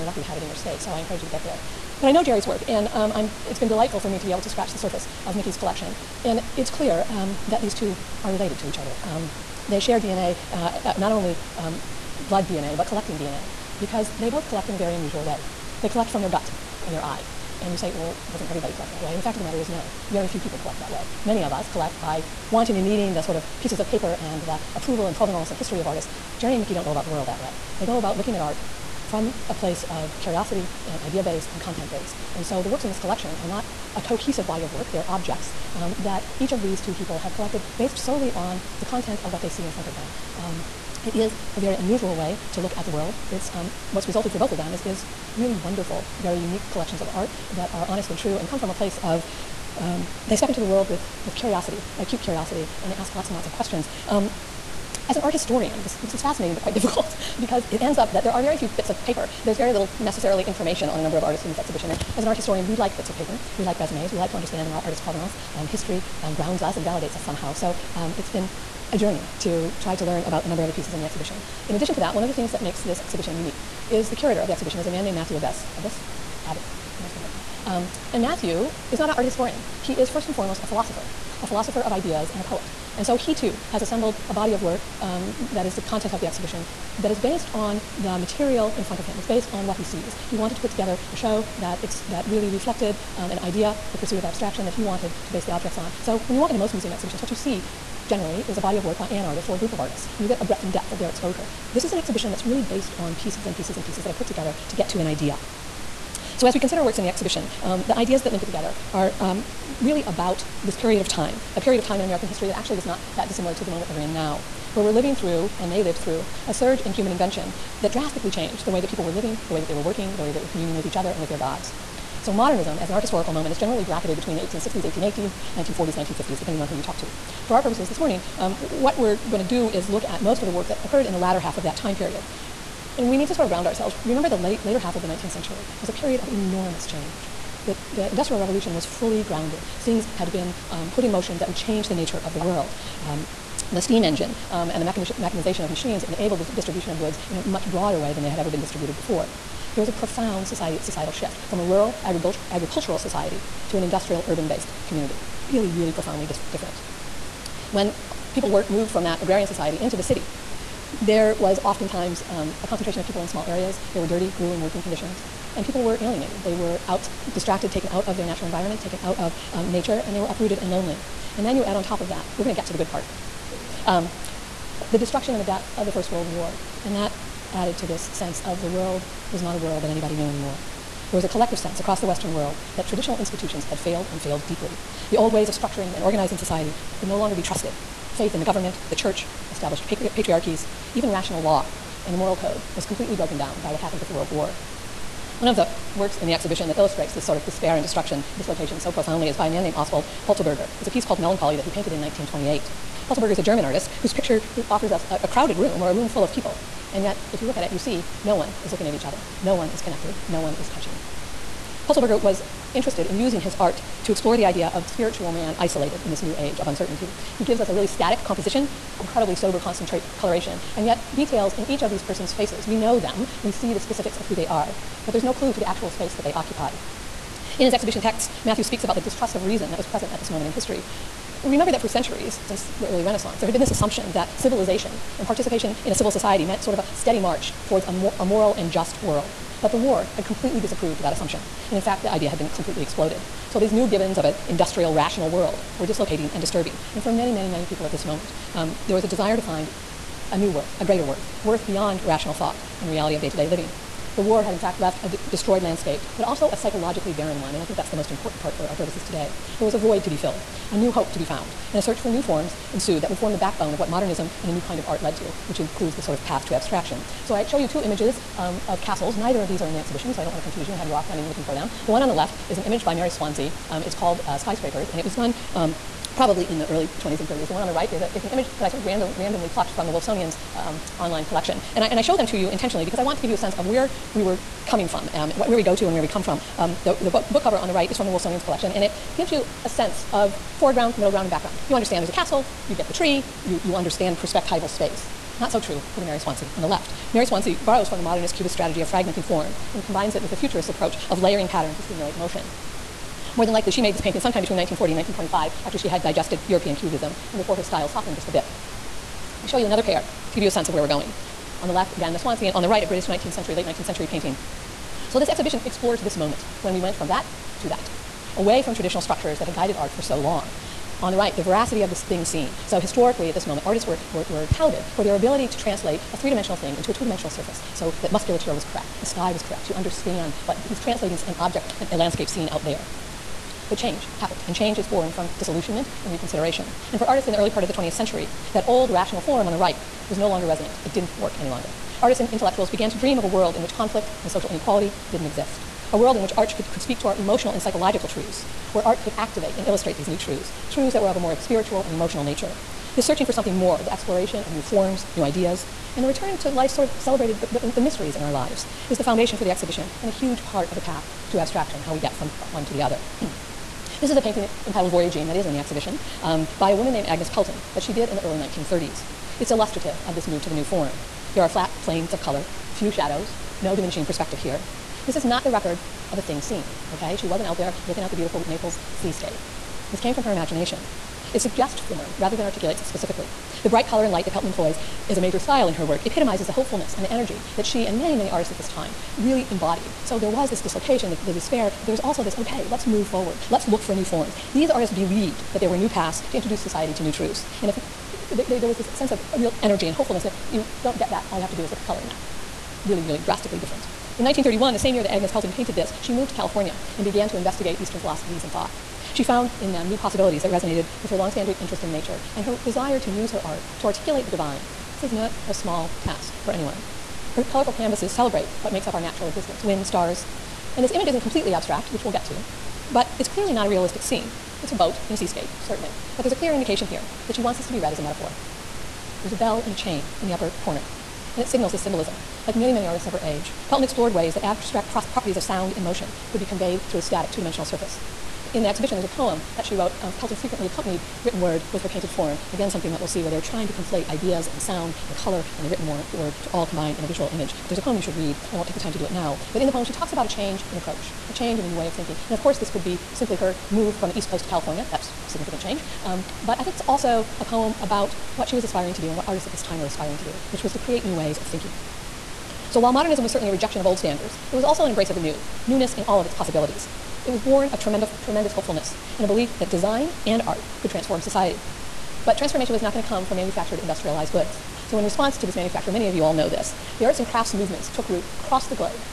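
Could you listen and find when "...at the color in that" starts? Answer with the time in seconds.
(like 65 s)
401 s.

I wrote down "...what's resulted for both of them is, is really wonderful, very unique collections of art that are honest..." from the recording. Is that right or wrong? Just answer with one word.
right.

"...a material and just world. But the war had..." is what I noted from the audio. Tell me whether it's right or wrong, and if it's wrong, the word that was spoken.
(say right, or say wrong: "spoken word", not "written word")
wrong: "moral", not "material".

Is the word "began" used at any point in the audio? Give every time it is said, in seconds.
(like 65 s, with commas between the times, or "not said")
342 s, 407 s.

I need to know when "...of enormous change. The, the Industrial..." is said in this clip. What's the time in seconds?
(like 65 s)
136 s.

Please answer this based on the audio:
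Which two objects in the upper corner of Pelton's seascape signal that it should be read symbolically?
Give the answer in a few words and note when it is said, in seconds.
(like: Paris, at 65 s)
A bell and a chain, at 429 s.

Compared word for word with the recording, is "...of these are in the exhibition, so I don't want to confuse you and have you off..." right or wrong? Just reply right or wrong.
right.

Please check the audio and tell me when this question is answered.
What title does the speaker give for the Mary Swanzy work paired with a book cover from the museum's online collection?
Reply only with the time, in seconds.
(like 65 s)
274 s.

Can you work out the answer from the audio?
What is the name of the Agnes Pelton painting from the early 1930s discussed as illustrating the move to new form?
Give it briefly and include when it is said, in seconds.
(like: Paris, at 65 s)
Voyaging, at 364 s.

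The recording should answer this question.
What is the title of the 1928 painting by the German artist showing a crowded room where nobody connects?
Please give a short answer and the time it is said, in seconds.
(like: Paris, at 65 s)
Melancholy, at 201 s.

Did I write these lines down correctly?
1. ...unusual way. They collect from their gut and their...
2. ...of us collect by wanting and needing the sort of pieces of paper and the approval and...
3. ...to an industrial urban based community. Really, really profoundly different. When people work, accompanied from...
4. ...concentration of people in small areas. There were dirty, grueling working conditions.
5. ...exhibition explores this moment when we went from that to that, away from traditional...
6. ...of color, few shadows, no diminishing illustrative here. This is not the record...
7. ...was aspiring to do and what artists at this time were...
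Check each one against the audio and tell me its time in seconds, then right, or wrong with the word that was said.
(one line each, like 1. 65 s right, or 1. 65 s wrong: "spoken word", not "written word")
1. 14 s right
2. 21 s right
3. 153 s wrong: "moved", not "accompanied"
4. 162 s right
5. 315 s right
6. 372 s wrong: "perspective", not "illustrative"
7. 458 s right.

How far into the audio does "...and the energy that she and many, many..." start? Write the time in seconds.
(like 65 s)
386 s.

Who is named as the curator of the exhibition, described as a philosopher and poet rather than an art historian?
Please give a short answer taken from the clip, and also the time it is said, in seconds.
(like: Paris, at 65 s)
Matthew Abess, at 75 s.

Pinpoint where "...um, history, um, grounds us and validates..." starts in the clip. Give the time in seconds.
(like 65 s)
65 s.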